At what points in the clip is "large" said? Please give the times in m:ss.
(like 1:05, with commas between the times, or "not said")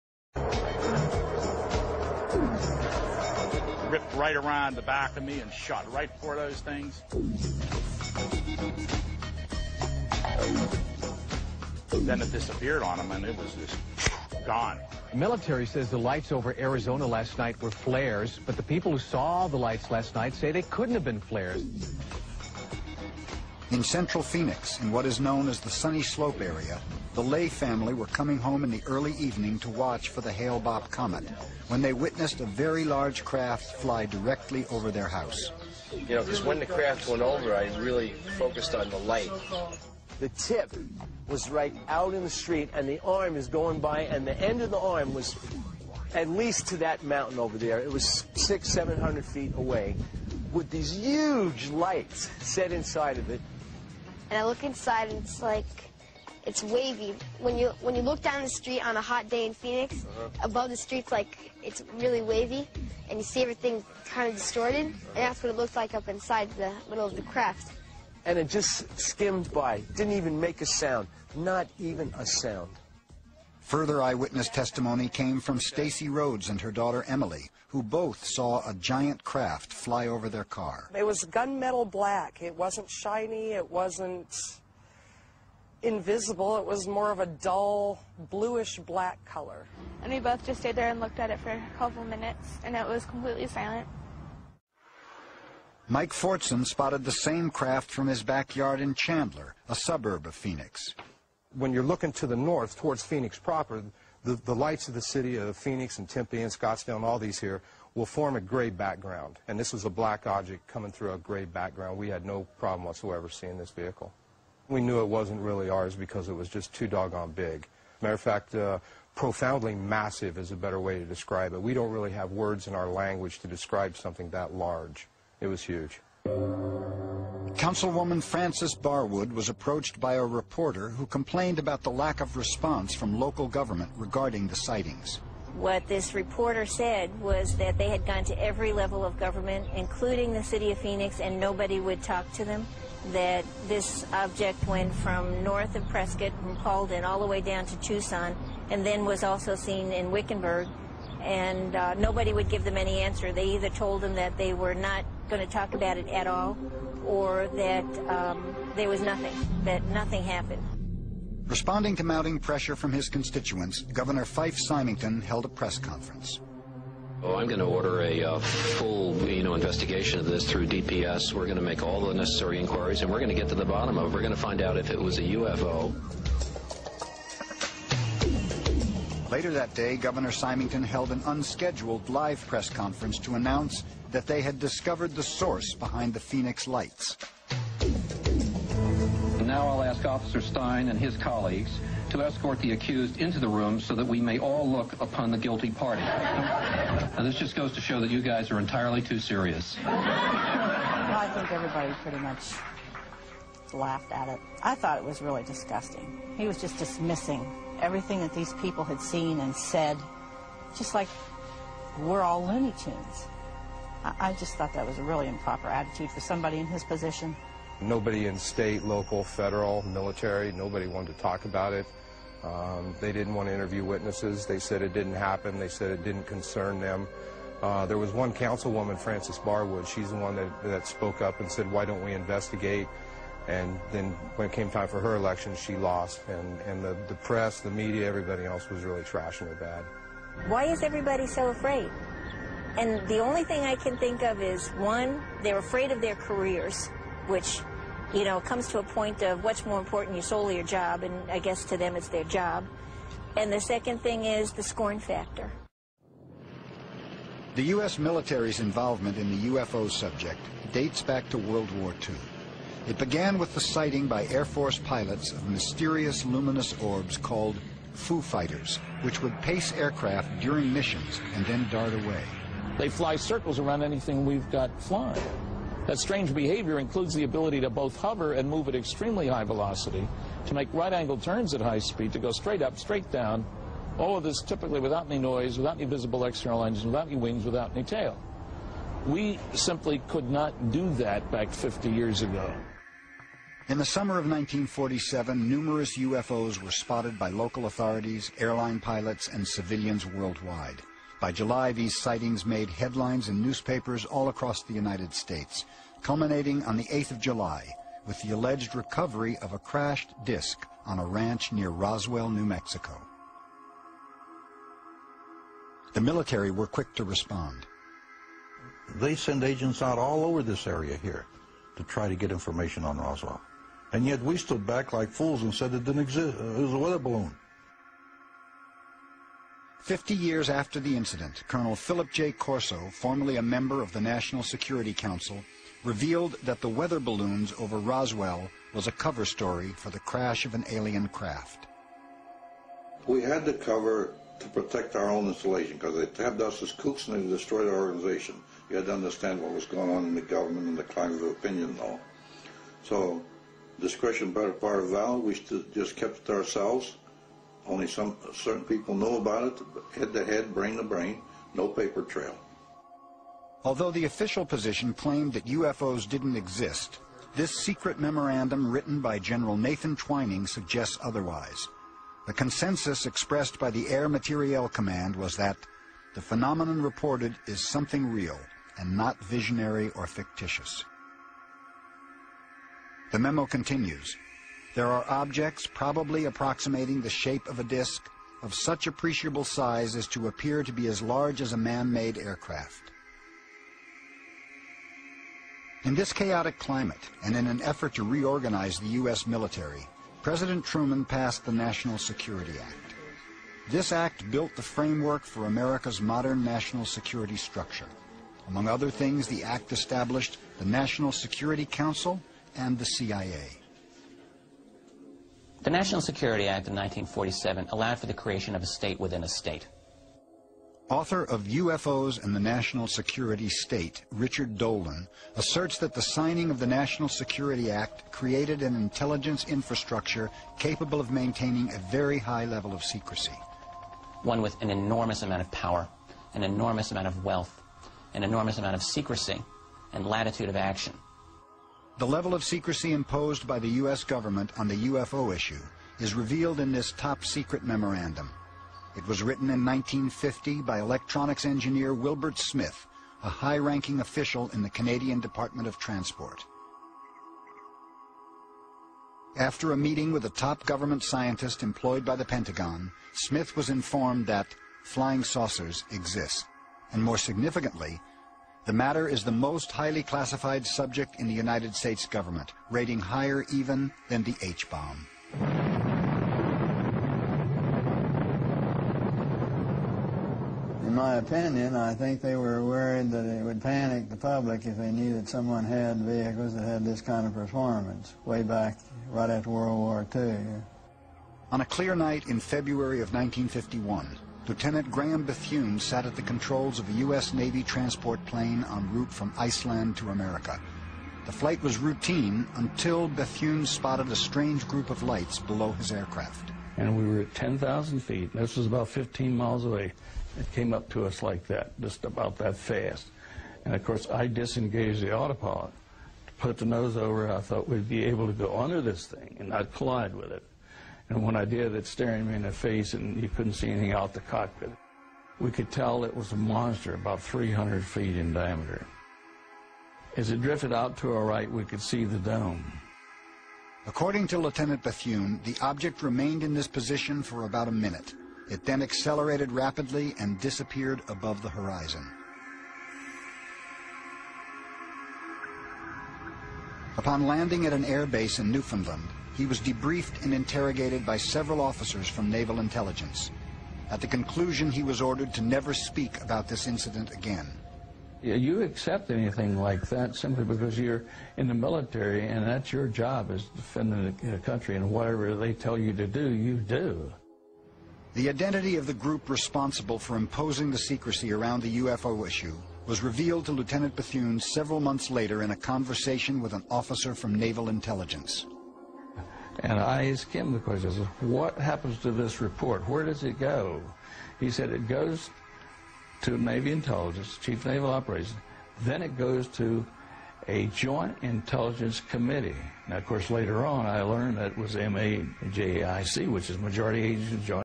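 0:32, 2:04, 6:31.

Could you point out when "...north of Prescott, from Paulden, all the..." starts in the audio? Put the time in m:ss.
2:25.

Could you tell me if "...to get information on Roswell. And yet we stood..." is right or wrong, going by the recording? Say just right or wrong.
right.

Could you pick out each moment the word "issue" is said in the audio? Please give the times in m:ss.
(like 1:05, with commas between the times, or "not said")
7:25, 9:32.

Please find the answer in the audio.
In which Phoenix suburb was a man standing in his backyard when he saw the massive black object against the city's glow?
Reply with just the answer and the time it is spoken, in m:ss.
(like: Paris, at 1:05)
Chandler, at 1:38.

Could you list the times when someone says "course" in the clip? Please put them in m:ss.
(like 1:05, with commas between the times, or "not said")
8:33, 9:53.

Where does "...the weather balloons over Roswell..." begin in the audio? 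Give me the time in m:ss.
5:36.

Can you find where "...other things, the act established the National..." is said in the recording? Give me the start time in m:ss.
6:48.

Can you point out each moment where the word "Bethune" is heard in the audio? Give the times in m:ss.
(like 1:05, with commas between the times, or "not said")
8:15, 8:23, 8:54, 9:33.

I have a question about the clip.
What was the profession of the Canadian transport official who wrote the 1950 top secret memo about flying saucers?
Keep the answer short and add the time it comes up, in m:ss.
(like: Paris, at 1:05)
electronics engineer, at 7:30.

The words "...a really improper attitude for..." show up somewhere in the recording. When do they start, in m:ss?
3:34.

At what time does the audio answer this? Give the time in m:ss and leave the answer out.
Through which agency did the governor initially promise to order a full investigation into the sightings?
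2:50.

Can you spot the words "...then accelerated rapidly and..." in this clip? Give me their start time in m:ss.
8:58.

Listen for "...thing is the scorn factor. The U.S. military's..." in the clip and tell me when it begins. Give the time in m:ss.
4:14.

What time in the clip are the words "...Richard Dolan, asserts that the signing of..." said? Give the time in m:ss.
7:04.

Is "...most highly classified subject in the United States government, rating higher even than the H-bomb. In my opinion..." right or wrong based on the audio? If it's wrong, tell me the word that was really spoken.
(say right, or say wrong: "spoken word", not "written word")
right.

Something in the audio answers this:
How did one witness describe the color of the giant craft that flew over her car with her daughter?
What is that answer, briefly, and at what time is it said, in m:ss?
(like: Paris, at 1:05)
dull bluish black, at 1:27.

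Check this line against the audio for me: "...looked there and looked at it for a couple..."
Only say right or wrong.
wrong.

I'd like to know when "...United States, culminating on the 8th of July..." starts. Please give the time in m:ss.
5:04.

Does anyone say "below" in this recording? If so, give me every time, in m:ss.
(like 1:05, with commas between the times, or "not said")
8:25.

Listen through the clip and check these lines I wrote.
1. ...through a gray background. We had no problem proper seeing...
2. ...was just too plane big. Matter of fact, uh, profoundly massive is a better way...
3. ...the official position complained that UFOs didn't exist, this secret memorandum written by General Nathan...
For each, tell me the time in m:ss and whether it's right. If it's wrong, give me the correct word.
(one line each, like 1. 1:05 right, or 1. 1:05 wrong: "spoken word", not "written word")
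1. 1:50 wrong: "whatsoever", not "proper"
2. 1:56 wrong: "doggone", not "plane"
3. 6:03 wrong: "claimed", not "complained".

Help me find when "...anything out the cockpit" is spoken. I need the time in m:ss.
8:43.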